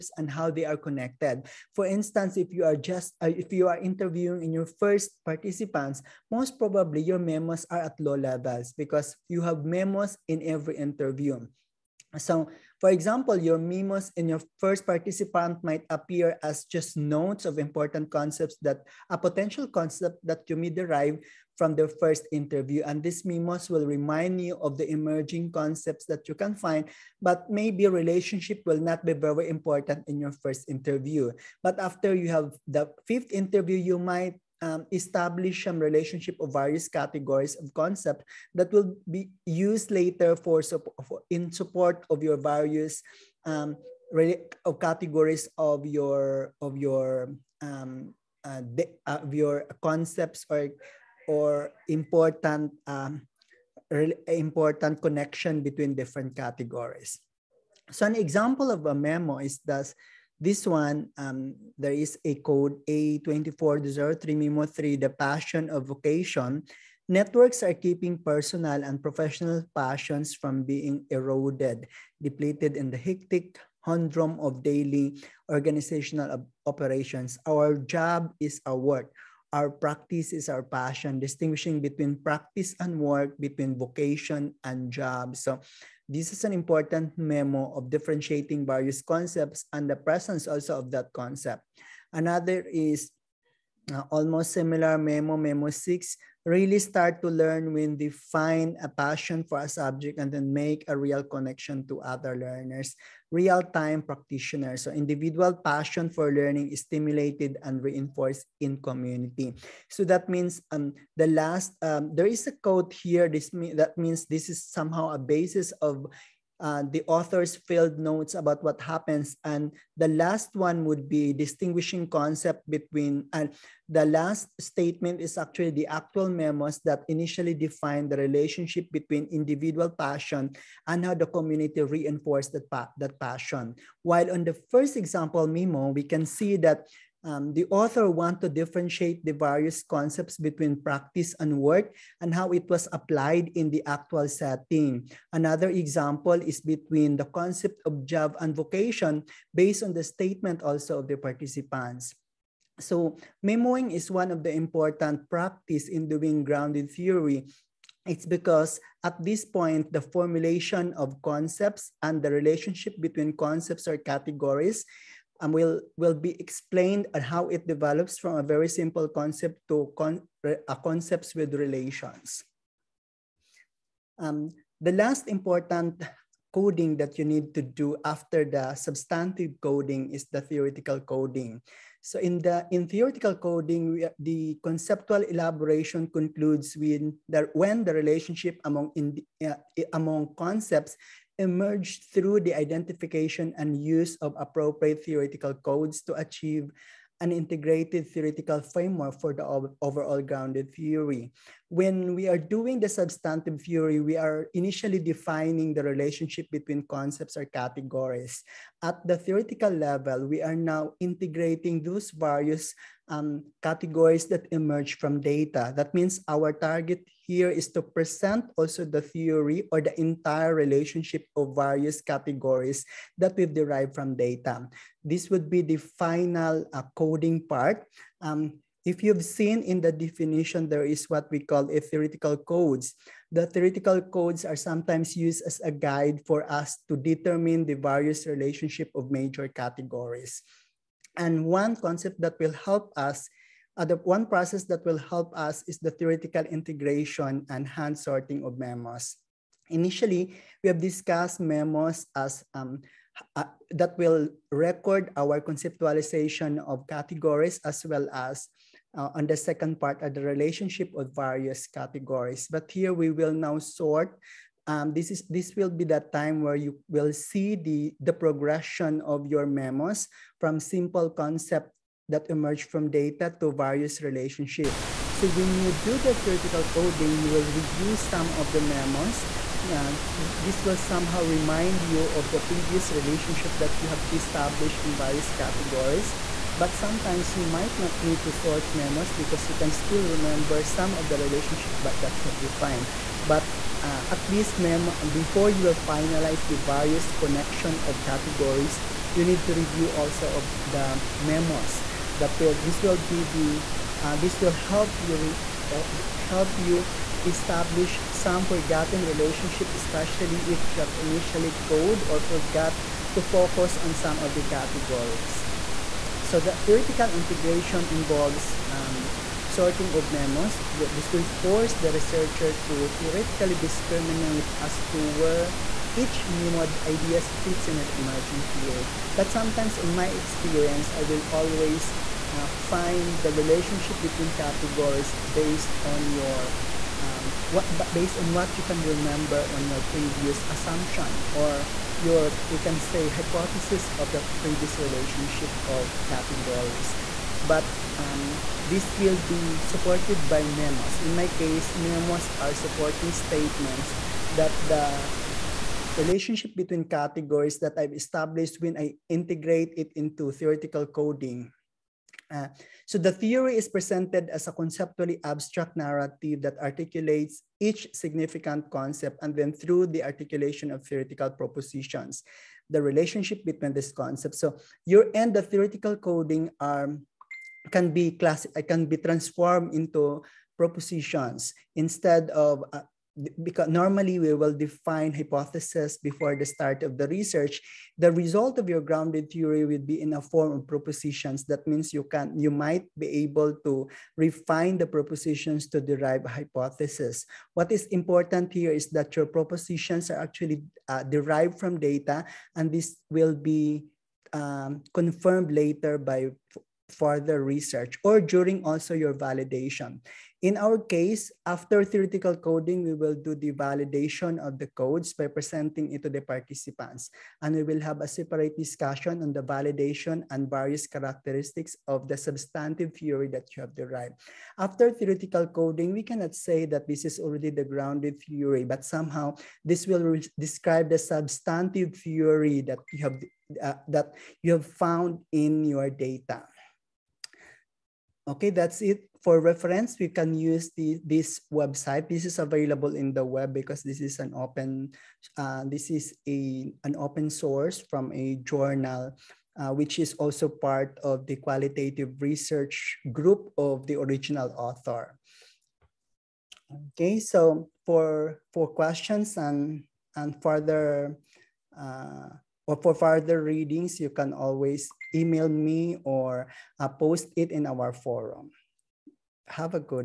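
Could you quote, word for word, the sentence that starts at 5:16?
So the theoretical integration involves um, sorting of memos.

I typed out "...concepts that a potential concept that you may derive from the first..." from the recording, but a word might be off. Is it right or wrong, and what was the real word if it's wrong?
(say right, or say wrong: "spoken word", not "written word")
right.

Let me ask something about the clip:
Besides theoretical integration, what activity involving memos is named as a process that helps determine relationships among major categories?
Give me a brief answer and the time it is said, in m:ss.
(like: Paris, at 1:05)
hand sorting, at 4:07.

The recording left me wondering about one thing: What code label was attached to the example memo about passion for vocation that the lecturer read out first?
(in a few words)
A2403 Memo 3.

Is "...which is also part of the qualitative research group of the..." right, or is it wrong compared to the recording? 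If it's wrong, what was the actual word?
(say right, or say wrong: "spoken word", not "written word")
right.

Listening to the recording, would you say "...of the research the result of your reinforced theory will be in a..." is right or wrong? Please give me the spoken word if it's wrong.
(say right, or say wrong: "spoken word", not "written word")
wrong: "grounded", not "reinforced".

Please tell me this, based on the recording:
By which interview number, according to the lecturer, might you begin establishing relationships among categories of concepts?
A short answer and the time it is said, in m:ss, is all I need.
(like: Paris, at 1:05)
fifth, at 0:33.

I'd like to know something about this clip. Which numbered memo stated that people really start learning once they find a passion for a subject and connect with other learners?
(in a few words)
Memo 6.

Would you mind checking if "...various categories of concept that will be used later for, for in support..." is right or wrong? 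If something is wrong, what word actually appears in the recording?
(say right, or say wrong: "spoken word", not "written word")
right.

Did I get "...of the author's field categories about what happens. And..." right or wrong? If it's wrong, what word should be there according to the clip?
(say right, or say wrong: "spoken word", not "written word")
wrong: "notes", not "categories".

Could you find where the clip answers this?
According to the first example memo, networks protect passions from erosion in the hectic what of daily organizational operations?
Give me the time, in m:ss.
1:13.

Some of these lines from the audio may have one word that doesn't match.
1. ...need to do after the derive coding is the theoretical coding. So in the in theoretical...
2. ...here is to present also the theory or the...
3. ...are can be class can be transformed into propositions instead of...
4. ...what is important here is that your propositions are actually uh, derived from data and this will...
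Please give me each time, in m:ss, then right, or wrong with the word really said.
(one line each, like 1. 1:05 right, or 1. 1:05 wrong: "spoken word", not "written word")
1. 2:57 wrong: "substantive", not "derive"
2. 3:37 right
3. 6:16 right
4. 6:37 right.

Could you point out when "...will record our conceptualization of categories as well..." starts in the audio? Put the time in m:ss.
4:13.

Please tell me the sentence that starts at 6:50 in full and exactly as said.
In our case, after theoretical coding, we will do the validation of the codes by presenting it to the participants.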